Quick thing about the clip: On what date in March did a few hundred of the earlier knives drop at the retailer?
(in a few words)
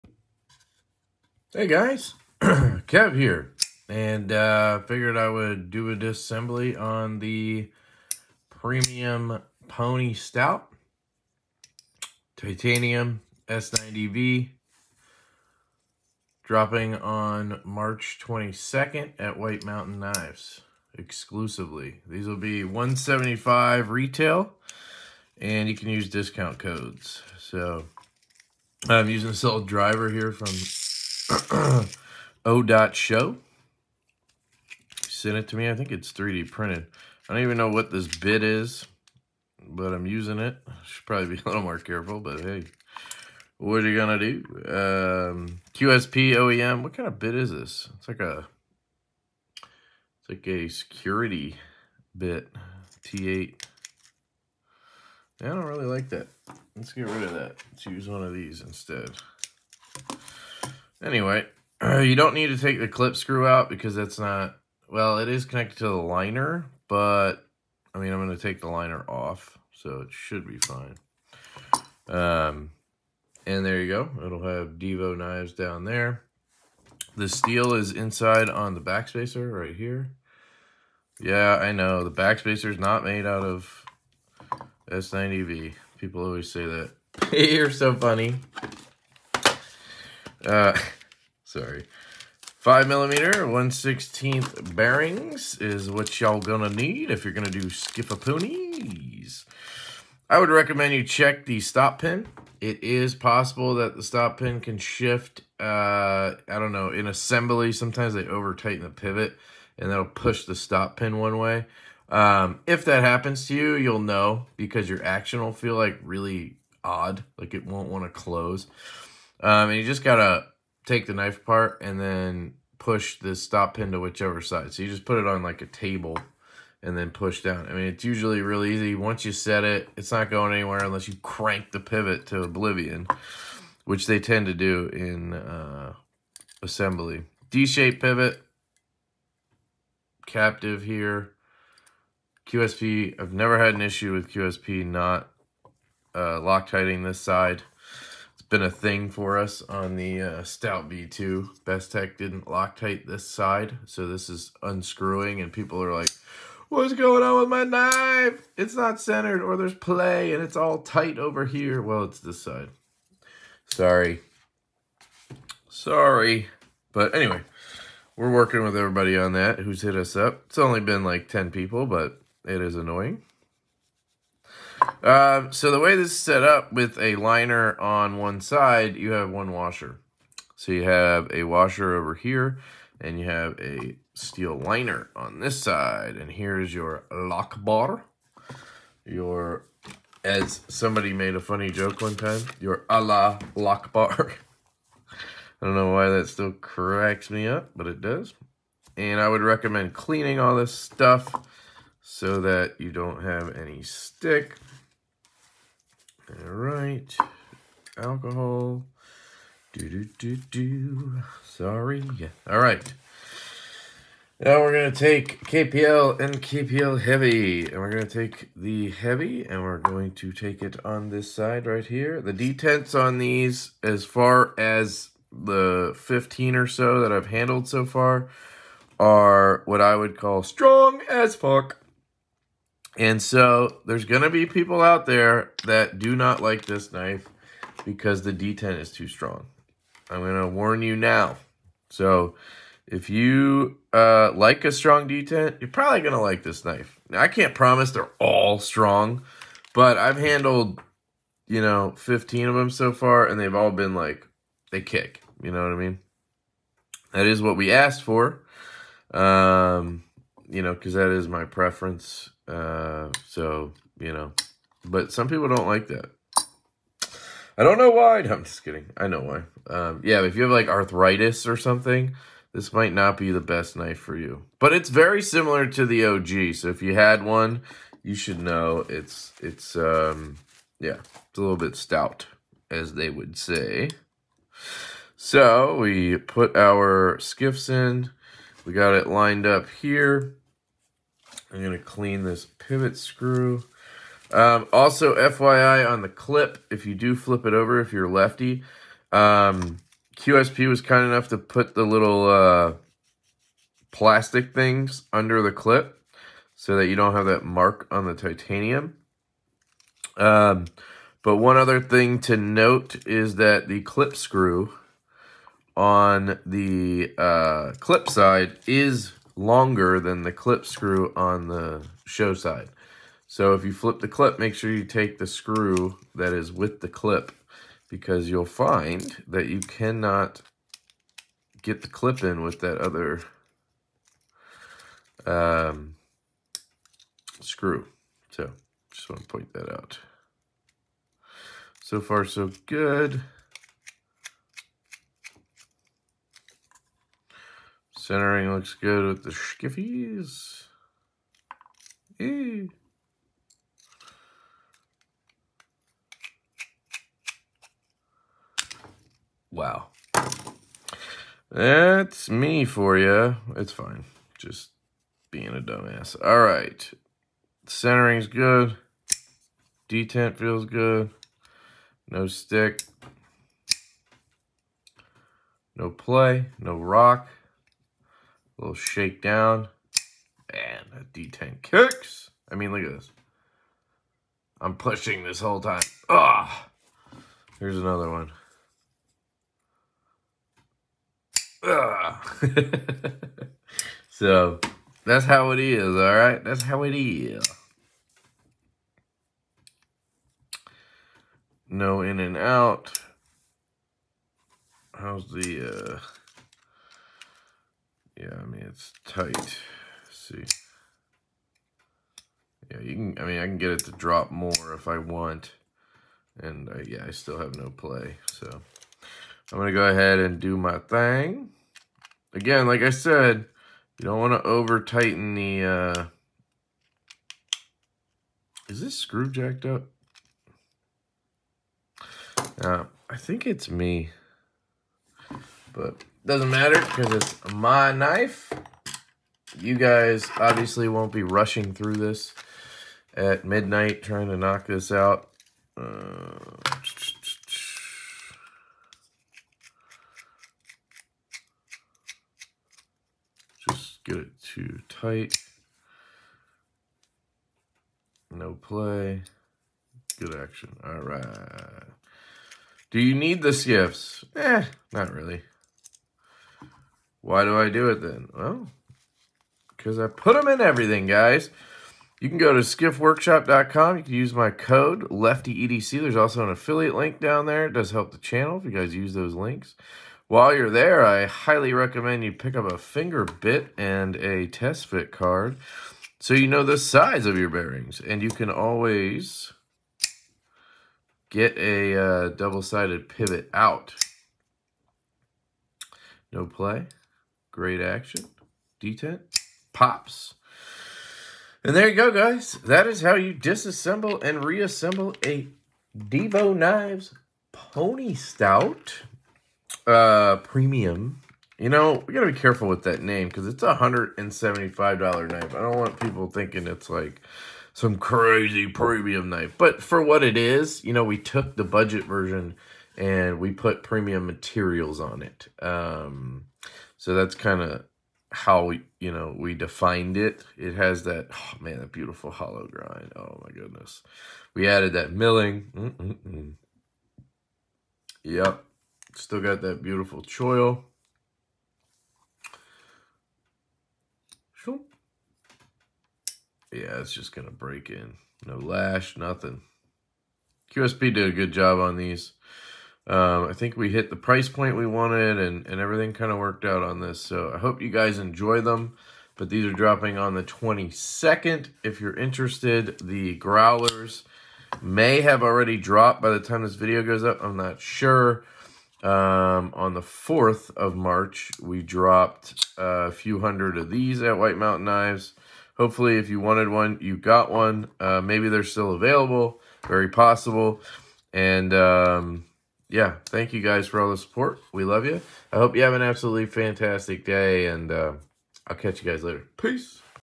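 March 4.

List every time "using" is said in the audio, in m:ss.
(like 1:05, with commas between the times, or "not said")
0:29, 0:40.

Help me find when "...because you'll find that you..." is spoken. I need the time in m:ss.
5:27.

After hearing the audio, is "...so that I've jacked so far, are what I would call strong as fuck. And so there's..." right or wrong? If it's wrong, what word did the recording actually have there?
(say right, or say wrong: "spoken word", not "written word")
wrong: "handled", not "jacked".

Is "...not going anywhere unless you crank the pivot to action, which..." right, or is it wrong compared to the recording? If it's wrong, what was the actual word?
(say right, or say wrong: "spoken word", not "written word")
wrong: "oblivion", not "action".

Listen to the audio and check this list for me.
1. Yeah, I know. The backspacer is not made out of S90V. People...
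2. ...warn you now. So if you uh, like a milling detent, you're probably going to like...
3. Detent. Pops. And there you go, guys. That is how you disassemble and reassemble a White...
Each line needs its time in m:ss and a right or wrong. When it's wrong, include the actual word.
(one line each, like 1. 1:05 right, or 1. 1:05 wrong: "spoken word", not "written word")
1. 1:21 right
2. 4:00 wrong: "strong", not "milling"
3. 8:18 wrong: "Divo", not "White".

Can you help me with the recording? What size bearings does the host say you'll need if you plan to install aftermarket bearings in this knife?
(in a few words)
5 millimeter, 1/16.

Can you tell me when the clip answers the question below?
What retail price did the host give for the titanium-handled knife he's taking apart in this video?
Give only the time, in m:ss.
0:22.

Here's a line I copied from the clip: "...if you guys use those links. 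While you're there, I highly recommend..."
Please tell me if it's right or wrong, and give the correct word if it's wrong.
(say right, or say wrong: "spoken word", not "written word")
right.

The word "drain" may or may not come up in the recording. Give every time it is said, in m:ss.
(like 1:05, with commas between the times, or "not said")
not said.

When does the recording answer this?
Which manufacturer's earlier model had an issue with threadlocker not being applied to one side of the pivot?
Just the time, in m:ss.
2:31.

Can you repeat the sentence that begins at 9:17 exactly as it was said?
So I hope you guys enjoy them.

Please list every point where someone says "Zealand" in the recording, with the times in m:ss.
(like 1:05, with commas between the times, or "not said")
not said.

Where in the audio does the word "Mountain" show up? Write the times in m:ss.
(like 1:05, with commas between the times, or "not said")
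0:19, 9:34.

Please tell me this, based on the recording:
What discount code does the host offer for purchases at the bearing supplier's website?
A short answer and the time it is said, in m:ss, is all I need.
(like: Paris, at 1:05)
LeftyEDC, at 7:55.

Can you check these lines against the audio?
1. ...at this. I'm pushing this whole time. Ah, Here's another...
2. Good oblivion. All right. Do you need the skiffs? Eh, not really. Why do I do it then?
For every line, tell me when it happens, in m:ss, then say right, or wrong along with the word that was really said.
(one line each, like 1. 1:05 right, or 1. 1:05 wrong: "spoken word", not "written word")
1. 6:22 right
2. 7:40 wrong: "action", not "oblivion".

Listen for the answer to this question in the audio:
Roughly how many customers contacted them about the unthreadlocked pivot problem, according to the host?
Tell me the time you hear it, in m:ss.
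2:51.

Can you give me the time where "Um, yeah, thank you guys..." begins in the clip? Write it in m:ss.
9:41.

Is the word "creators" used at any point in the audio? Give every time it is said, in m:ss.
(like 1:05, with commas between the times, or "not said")
not said.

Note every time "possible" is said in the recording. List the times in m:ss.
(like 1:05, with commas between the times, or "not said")
1:43, 9:40.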